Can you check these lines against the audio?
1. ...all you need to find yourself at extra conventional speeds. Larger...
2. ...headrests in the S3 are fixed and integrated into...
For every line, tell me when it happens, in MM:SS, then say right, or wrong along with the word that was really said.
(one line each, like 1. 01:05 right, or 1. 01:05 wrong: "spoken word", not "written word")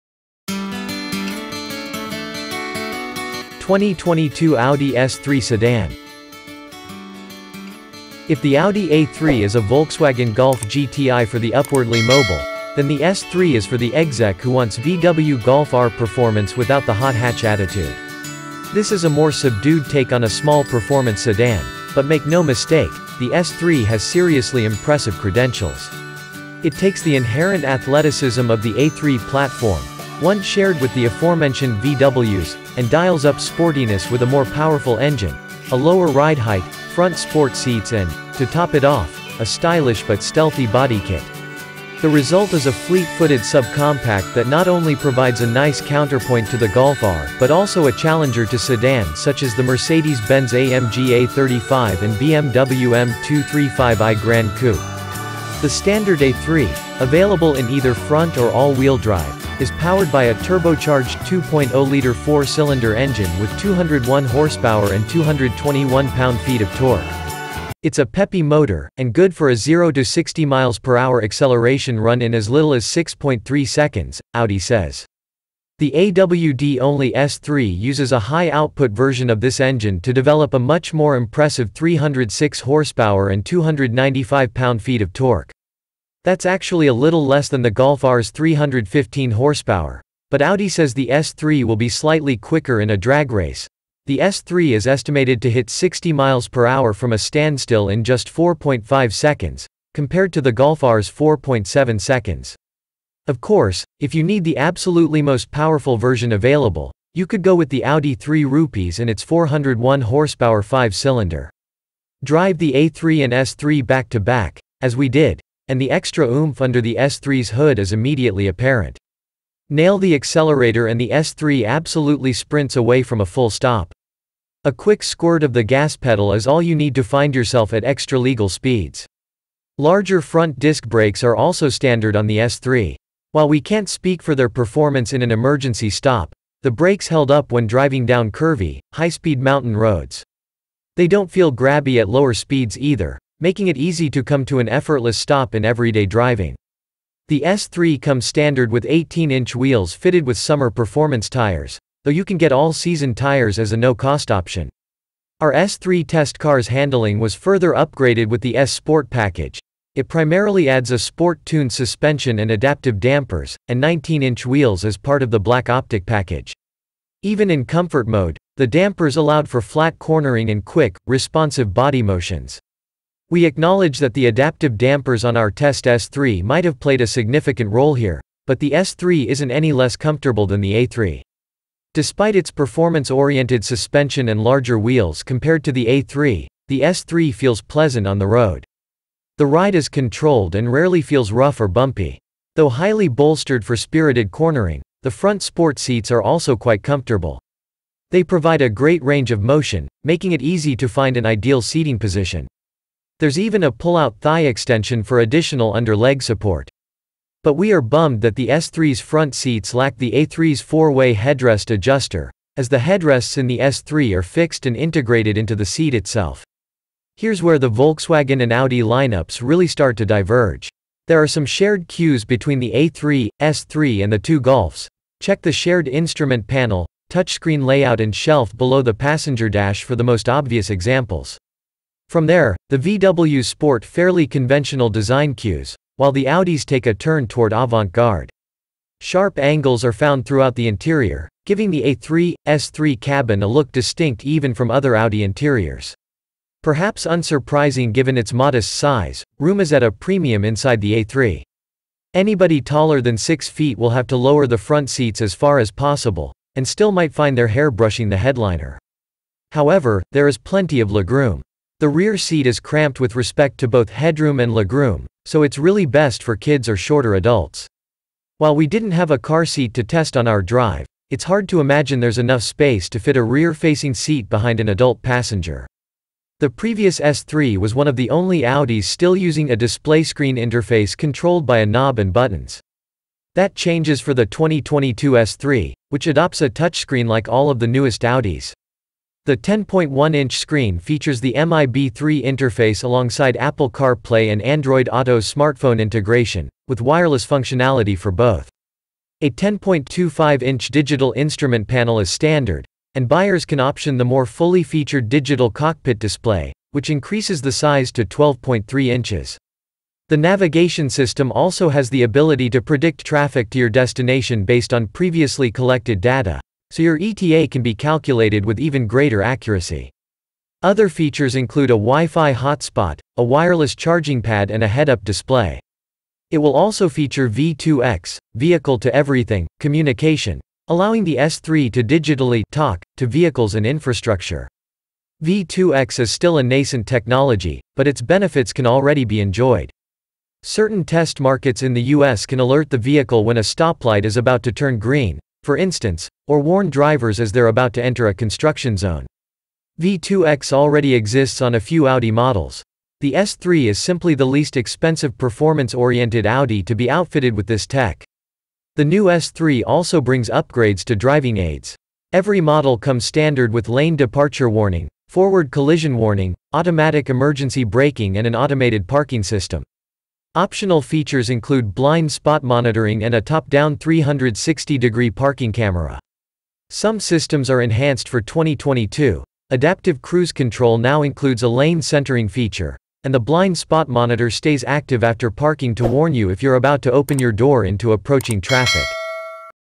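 1. 02:06 wrong: "legal", not "conventional"
2. 03:32 right.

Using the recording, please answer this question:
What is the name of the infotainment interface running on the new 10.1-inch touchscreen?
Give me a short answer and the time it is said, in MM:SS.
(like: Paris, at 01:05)
MIB3, at 04:51.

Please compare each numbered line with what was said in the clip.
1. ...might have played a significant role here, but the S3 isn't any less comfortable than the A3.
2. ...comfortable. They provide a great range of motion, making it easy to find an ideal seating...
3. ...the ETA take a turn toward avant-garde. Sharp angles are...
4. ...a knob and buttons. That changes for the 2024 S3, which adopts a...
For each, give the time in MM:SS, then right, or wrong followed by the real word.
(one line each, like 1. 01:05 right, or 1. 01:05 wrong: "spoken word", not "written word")
1. 02:56 right
2. 03:16 right
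3. 03:56 wrong: "Audis", not "ETA"
4. 04:41 wrong: "2022", not "2024".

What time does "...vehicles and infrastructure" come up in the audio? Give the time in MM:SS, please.
05:33.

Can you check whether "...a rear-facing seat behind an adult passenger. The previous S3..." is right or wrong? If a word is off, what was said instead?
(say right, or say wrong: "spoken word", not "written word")
right.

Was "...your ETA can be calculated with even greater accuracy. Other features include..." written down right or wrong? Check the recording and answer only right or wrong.
right.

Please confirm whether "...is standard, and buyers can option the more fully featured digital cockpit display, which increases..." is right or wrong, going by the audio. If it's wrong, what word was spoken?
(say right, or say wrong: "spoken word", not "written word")
right.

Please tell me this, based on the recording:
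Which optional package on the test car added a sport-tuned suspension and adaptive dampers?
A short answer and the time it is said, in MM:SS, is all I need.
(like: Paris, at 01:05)
S Sport package, at 02:38.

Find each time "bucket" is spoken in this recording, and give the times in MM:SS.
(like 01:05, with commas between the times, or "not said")
not said.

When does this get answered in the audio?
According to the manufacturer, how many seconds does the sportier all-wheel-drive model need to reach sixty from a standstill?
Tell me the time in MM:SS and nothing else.
01:38.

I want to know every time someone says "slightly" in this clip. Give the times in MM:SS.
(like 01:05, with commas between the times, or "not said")
01:31.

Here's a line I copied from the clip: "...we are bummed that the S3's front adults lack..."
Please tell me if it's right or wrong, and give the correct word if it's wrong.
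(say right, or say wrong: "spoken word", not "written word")
wrong: "seats", not "adults".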